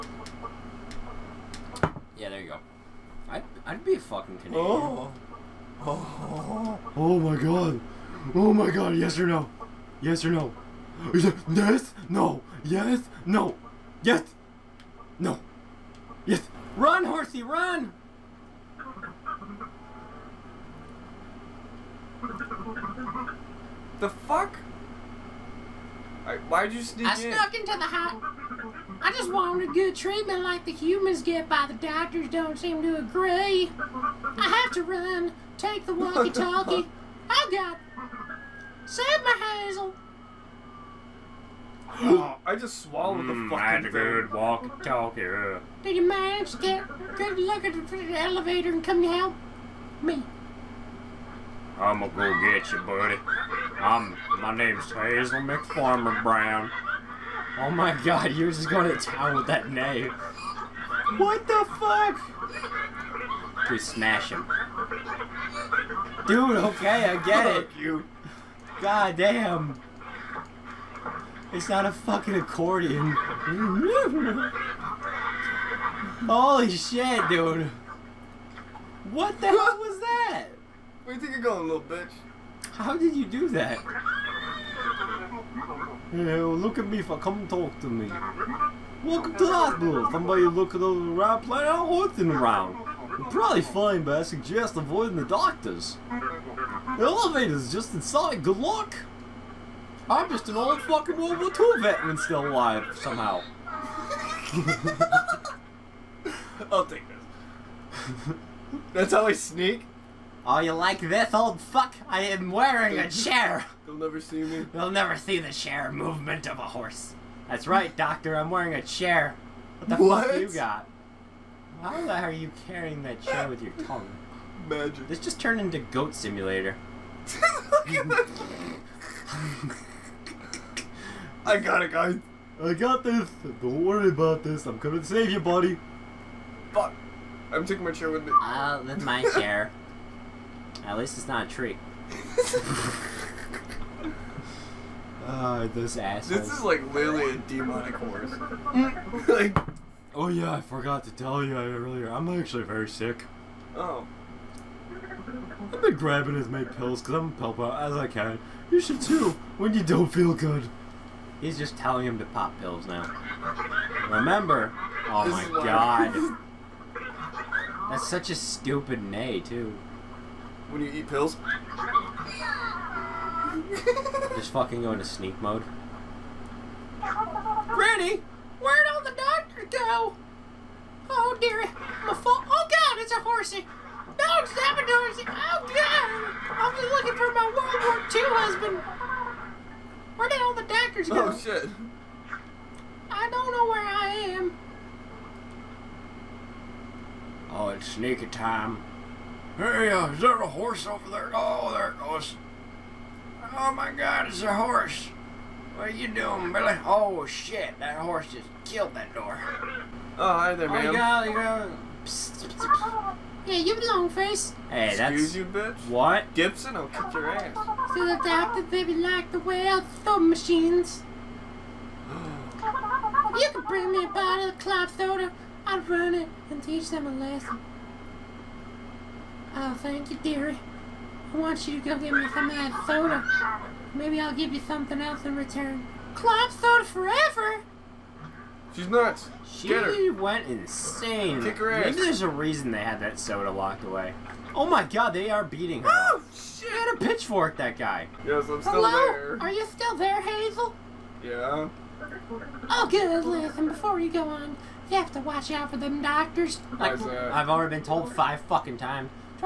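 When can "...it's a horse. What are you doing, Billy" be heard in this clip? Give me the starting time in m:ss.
3:24.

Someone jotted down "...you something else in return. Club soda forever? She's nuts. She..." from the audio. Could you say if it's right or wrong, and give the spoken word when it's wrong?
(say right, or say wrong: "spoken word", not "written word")
right.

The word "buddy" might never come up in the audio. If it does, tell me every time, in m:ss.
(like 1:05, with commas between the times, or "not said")
0:52, 2:15.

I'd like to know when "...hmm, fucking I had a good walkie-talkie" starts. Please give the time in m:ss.
0:43.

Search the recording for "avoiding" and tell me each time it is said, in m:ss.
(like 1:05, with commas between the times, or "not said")
1:34.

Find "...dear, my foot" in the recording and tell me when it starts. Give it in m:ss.
3:01.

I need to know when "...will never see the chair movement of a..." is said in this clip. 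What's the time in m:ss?
1:54.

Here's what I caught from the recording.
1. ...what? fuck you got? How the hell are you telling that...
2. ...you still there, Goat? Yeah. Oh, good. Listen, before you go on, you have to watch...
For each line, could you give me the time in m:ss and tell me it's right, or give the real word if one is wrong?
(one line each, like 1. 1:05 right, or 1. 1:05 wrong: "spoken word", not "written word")
1. 2:00 wrong: "carrying", not "telling"
2. 4:09 wrong: "Hazel", not "Goat".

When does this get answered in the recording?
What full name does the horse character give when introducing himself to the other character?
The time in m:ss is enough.
0:54.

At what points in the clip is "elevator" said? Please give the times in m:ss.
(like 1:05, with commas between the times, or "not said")
0:48, 1:37.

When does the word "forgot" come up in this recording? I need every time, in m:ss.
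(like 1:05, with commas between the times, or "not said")
2:30.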